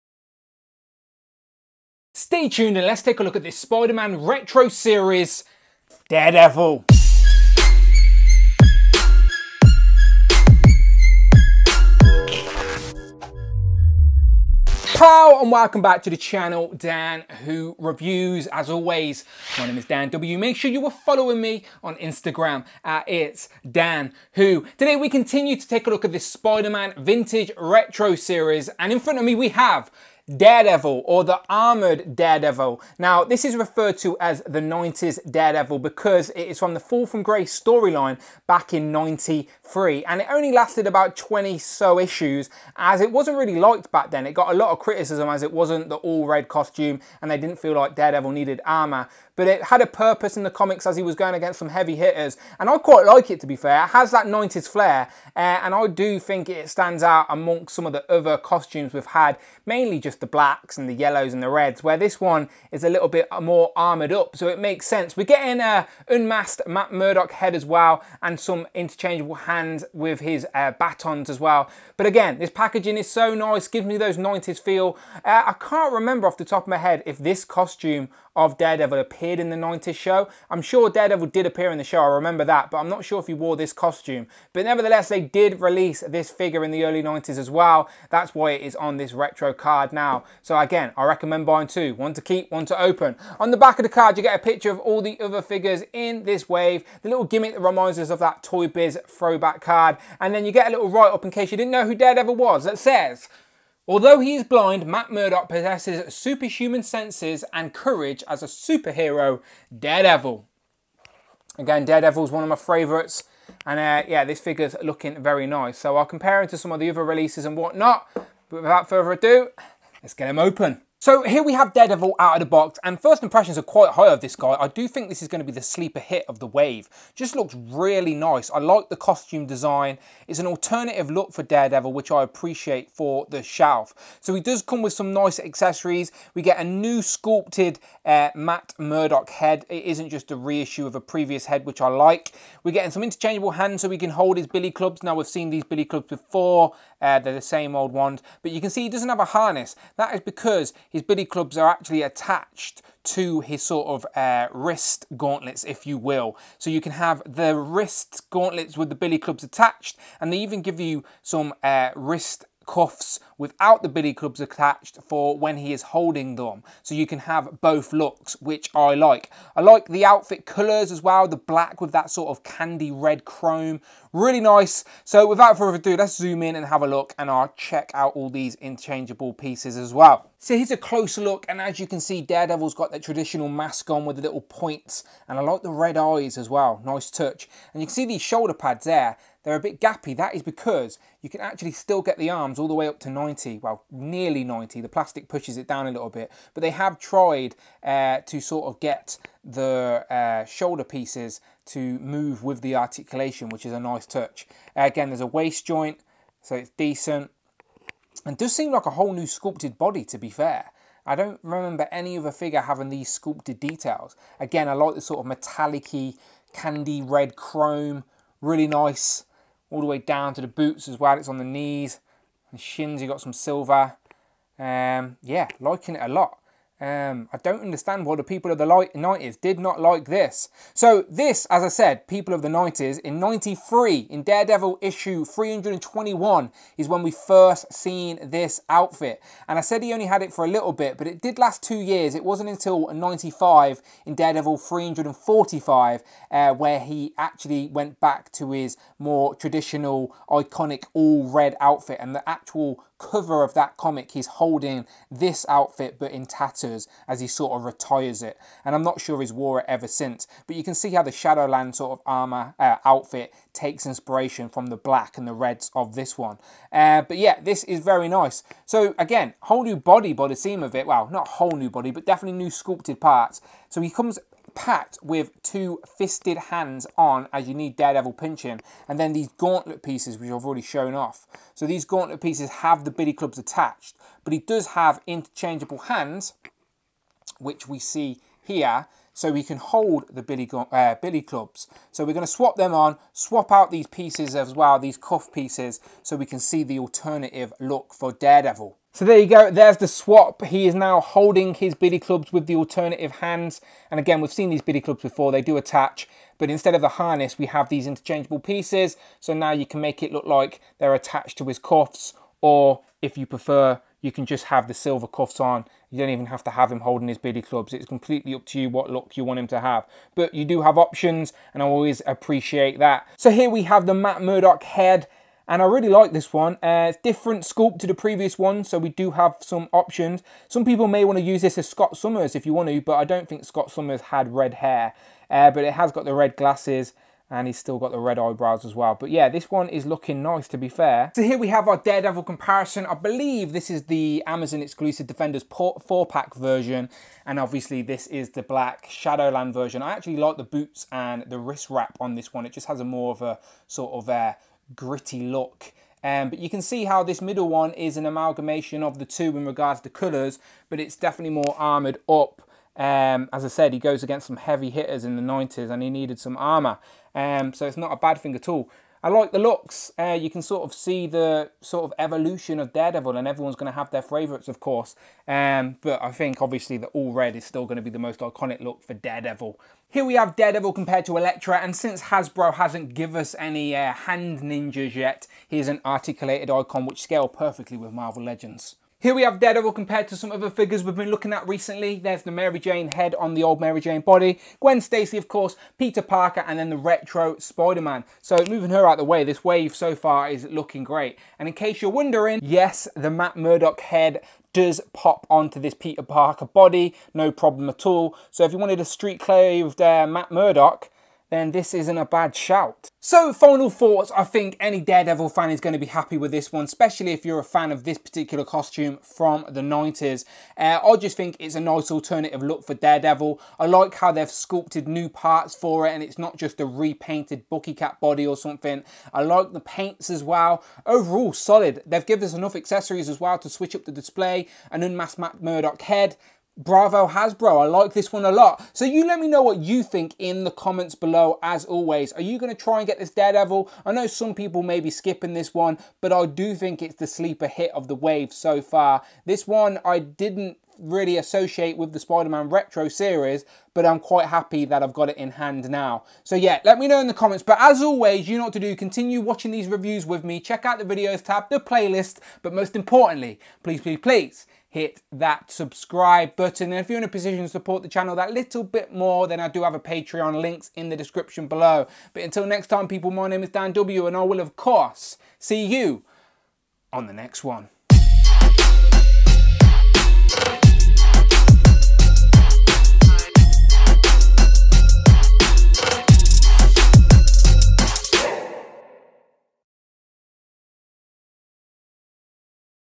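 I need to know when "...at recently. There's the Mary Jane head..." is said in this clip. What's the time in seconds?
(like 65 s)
391 s.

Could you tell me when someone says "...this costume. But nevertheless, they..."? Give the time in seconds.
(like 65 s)
83 s.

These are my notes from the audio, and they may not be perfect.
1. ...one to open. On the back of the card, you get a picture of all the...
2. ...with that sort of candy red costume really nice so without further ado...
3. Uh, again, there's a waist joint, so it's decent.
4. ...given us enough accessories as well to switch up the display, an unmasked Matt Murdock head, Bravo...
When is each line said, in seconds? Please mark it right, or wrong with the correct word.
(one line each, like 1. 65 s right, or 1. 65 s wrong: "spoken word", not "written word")
1. 92 s right
2. 171 s wrong: "chrome", not "costume"
3. 204 s right
4. 432 s right.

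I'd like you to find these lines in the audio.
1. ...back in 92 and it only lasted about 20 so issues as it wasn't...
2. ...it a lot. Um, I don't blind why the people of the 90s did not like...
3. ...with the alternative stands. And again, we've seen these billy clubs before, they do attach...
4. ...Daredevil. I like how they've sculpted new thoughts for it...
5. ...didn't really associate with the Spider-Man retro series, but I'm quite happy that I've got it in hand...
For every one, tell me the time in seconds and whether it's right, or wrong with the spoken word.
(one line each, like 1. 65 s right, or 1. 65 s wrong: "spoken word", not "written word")
1. 38 s wrong: "93", not "92"
2. 225 s wrong: "understand", not "blind"
3. 302 s wrong: "hands", not "stands"
4. 422 s wrong: "parts", not "thoughts"
5. 449 s right.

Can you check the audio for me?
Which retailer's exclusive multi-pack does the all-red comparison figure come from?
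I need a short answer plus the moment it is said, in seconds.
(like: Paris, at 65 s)
Amazon, at 344 s.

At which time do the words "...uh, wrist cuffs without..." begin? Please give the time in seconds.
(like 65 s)
161 s.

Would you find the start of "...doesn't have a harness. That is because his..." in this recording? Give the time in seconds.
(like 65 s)
148 s.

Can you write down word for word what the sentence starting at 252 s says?
And the actual cover of that comic, he's holding this outfit, but in tattoo as he sort of retires it.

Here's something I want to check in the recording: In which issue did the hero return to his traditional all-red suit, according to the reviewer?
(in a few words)
345.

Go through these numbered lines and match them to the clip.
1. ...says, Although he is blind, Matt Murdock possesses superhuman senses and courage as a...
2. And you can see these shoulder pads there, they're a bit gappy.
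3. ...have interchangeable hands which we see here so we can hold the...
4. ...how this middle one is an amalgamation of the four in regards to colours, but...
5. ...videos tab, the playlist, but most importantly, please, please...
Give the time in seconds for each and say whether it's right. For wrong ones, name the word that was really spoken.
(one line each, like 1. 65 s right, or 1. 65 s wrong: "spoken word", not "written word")
1. 102 s right
2. 187 s right
3. 284 s right
4. 356 s wrong: "two", not "four"
5. 460 s right.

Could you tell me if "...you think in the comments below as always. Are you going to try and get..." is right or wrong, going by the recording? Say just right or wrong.
right.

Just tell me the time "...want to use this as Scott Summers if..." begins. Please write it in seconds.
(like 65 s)
331 s.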